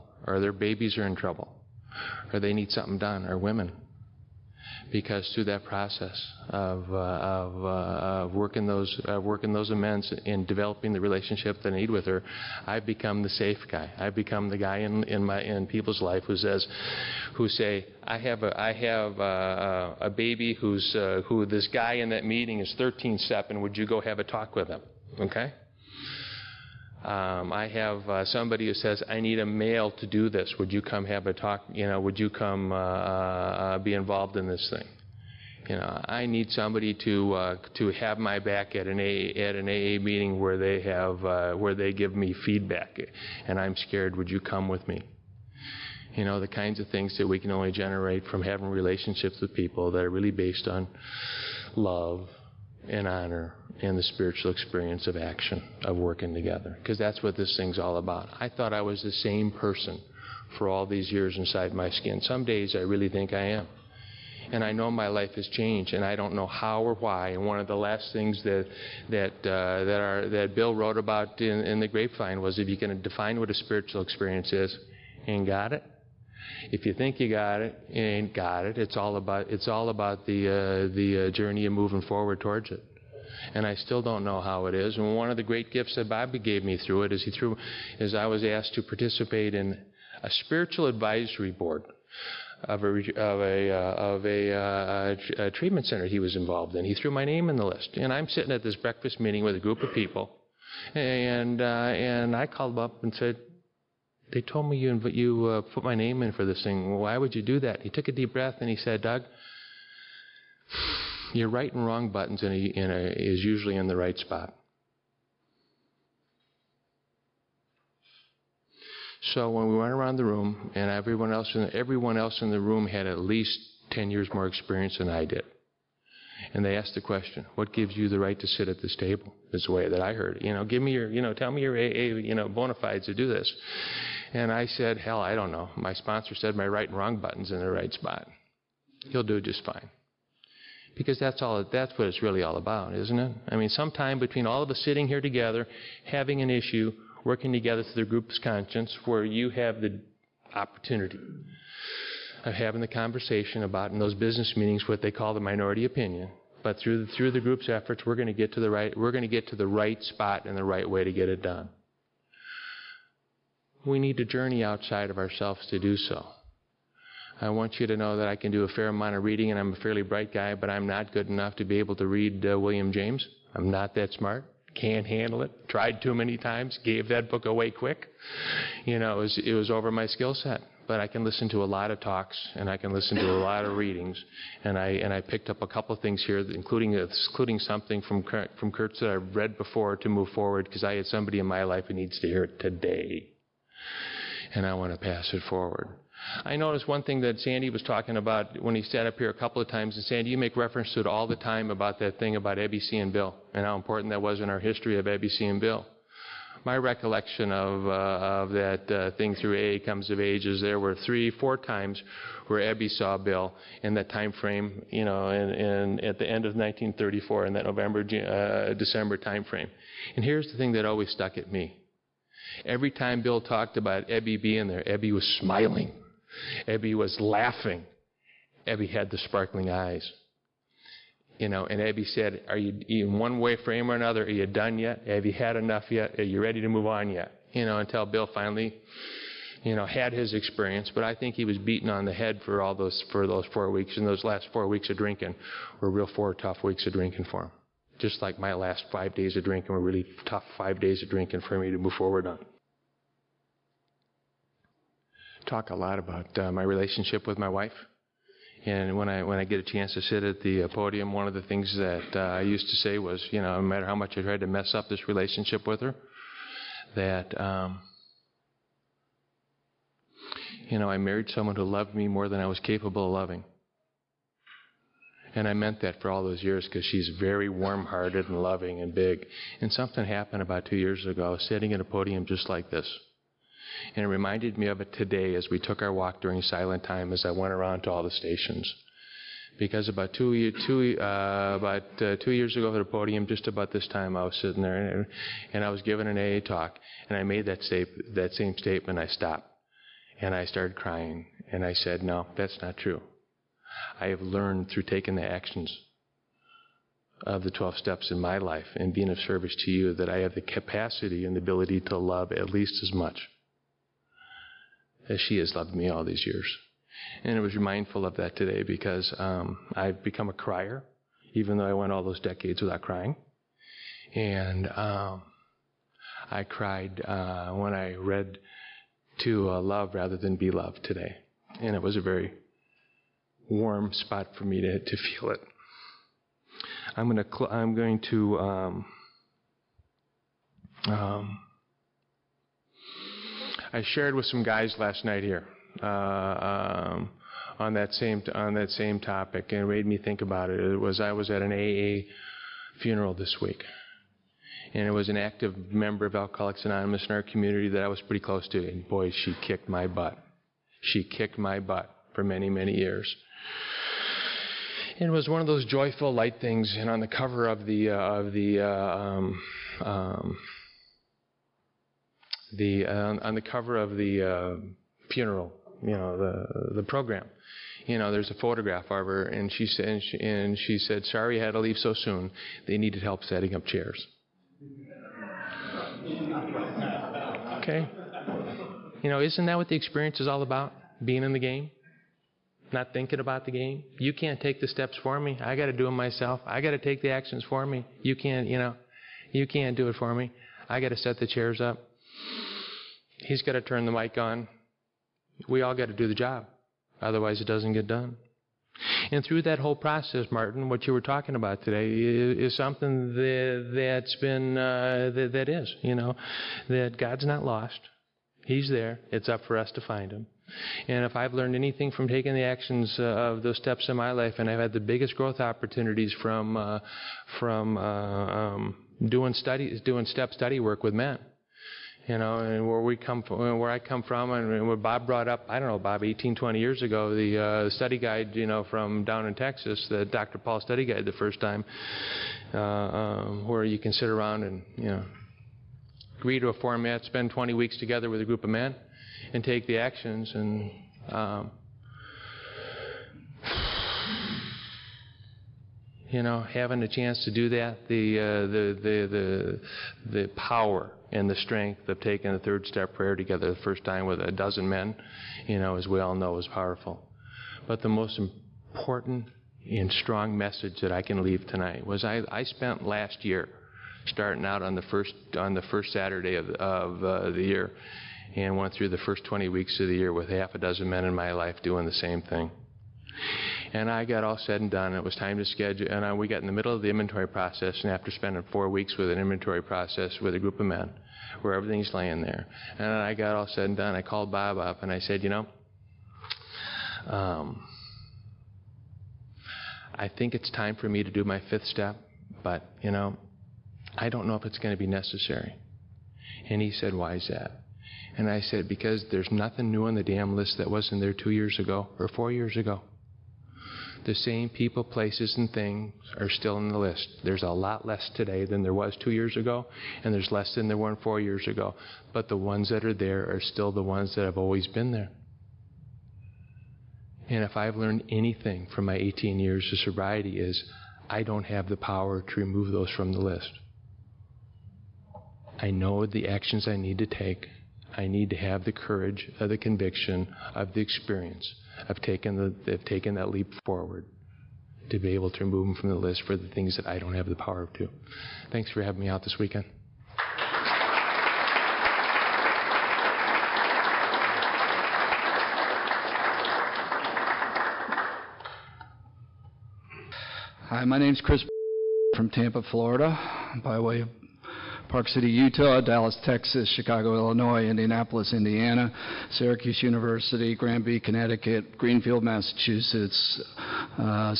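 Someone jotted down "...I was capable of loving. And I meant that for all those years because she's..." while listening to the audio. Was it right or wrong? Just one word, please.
right.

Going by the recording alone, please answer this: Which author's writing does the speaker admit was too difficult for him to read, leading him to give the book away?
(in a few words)
William James.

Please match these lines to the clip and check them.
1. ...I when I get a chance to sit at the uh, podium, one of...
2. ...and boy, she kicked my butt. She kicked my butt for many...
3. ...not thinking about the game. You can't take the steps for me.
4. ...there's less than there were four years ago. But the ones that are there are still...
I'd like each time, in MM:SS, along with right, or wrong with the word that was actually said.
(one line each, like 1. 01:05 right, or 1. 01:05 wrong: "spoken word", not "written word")
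1. 04:19 right
2. 05:58 right
3. 06:32 right
4. 08:40 right.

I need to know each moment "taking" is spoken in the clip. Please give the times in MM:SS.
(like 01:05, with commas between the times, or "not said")
05:04, 07:02, 07:41.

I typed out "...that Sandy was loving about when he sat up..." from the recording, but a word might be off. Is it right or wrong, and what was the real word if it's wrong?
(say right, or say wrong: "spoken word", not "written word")
wrong: "talking", not "loving".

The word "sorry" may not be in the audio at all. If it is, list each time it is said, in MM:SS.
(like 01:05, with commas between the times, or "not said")
06:21.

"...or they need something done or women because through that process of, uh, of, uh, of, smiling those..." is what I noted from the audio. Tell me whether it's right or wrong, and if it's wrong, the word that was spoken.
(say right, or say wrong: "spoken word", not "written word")
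wrong: "working", not "smiling".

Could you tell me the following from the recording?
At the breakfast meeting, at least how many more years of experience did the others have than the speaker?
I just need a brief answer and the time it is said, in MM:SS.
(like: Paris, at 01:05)
10 years, at 02:03.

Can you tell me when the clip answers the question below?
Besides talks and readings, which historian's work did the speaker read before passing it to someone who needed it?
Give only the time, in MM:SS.
03:08.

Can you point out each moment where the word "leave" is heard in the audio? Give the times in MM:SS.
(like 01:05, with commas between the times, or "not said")
06:21, 07:51.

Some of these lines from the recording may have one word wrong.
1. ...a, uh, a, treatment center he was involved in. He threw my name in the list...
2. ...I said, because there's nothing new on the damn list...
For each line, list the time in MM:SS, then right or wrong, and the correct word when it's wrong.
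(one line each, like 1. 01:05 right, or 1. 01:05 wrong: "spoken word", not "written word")
1. 01:34 right
2. 08:28 right.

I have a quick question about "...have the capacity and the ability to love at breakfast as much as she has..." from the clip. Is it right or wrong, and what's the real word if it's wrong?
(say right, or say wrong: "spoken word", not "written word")
wrong: "least", not "breakfast".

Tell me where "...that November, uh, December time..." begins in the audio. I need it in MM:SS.
03:37.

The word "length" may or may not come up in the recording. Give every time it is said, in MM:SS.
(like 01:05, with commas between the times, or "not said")
not said.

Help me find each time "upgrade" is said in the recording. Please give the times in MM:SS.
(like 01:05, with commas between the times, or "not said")
not said.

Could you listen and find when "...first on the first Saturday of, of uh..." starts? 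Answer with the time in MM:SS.
07:54.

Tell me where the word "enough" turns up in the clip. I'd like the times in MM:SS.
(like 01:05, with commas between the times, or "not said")
02:51, 03:55.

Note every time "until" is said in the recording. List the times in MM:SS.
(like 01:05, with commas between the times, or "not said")
03:57.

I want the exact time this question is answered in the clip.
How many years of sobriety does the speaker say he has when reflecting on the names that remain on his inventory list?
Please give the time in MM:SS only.
08:48.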